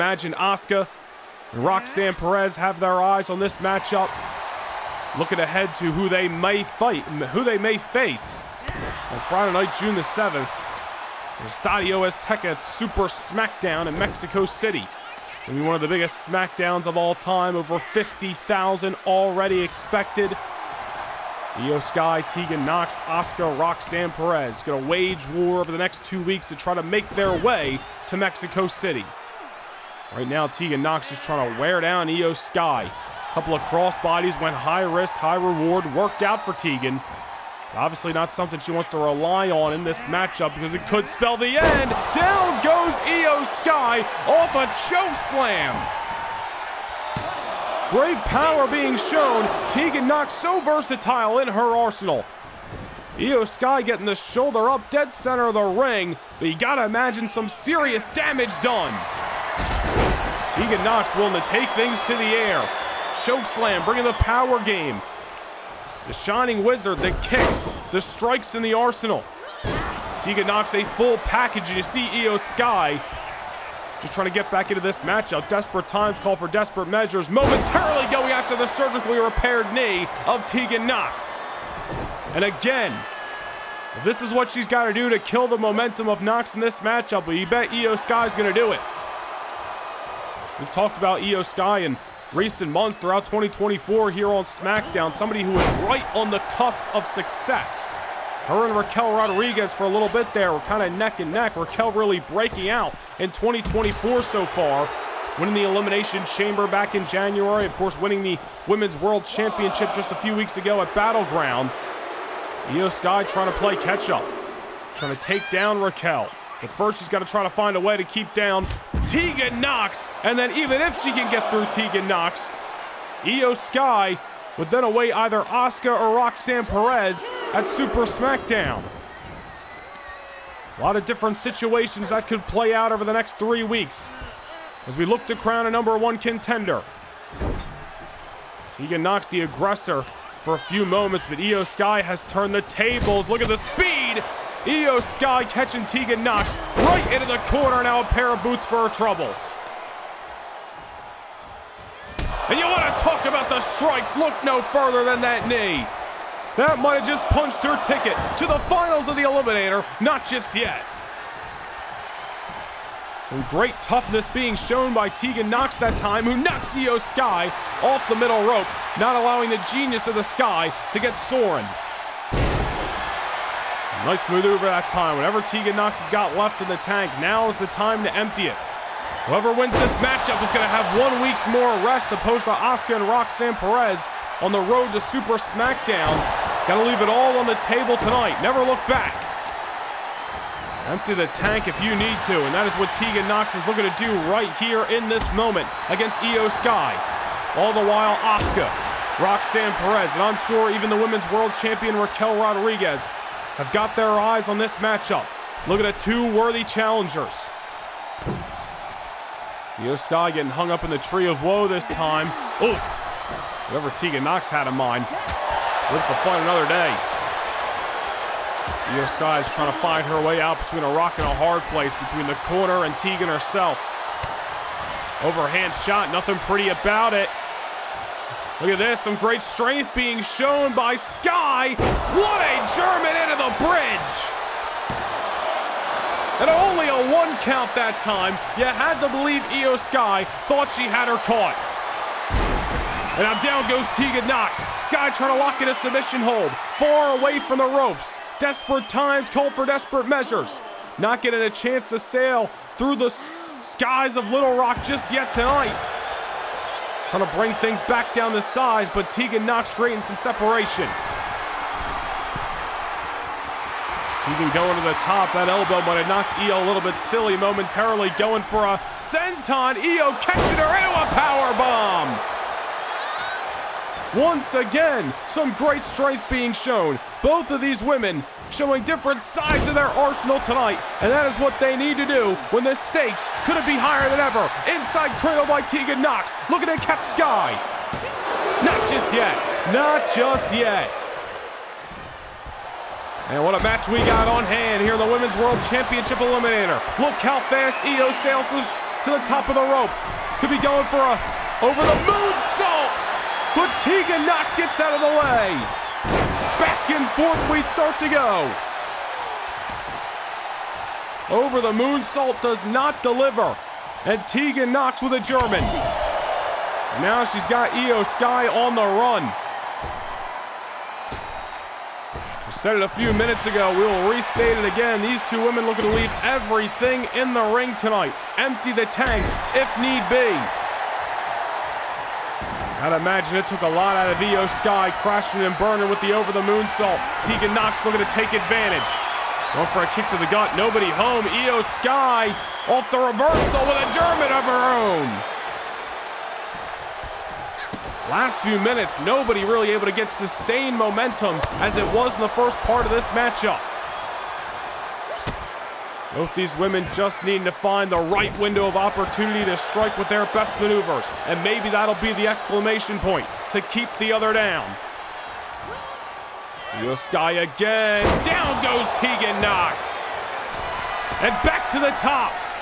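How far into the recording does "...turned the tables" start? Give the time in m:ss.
2:22.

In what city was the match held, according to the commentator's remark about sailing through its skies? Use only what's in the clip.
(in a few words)
Little Rock.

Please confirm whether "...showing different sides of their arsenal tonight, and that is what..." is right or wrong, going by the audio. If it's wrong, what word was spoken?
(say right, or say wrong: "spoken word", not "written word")
right.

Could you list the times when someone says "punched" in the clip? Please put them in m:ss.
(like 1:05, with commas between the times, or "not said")
2:37.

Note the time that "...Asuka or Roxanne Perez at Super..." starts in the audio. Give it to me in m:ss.
2:05.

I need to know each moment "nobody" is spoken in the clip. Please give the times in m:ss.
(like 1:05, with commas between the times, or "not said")
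5:40, 5:48.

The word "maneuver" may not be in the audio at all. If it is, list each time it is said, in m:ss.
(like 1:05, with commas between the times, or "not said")
2:54, 6:00.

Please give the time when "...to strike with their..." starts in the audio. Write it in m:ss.
5:59.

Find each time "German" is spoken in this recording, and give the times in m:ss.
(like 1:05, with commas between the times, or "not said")
3:52, 5:15, 5:43.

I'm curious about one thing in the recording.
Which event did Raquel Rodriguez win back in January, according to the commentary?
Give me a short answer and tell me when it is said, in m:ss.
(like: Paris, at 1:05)
Elimination Chamber, at 1:45.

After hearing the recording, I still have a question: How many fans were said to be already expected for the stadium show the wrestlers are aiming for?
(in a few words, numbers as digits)
Over 50,000.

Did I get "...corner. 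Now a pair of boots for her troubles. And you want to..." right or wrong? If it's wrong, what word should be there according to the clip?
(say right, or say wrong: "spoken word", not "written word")
right.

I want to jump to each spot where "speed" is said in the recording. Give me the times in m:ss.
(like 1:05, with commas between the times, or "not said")
2:23.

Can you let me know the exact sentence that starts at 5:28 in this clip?
Empty the tanks if need be.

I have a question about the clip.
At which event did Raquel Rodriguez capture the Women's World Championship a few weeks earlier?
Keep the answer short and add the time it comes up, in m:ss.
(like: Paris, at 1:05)
Battleground, at 1:50.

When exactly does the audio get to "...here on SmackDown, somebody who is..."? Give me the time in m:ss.
1:34.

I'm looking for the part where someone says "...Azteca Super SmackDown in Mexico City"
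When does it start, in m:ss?
0:12.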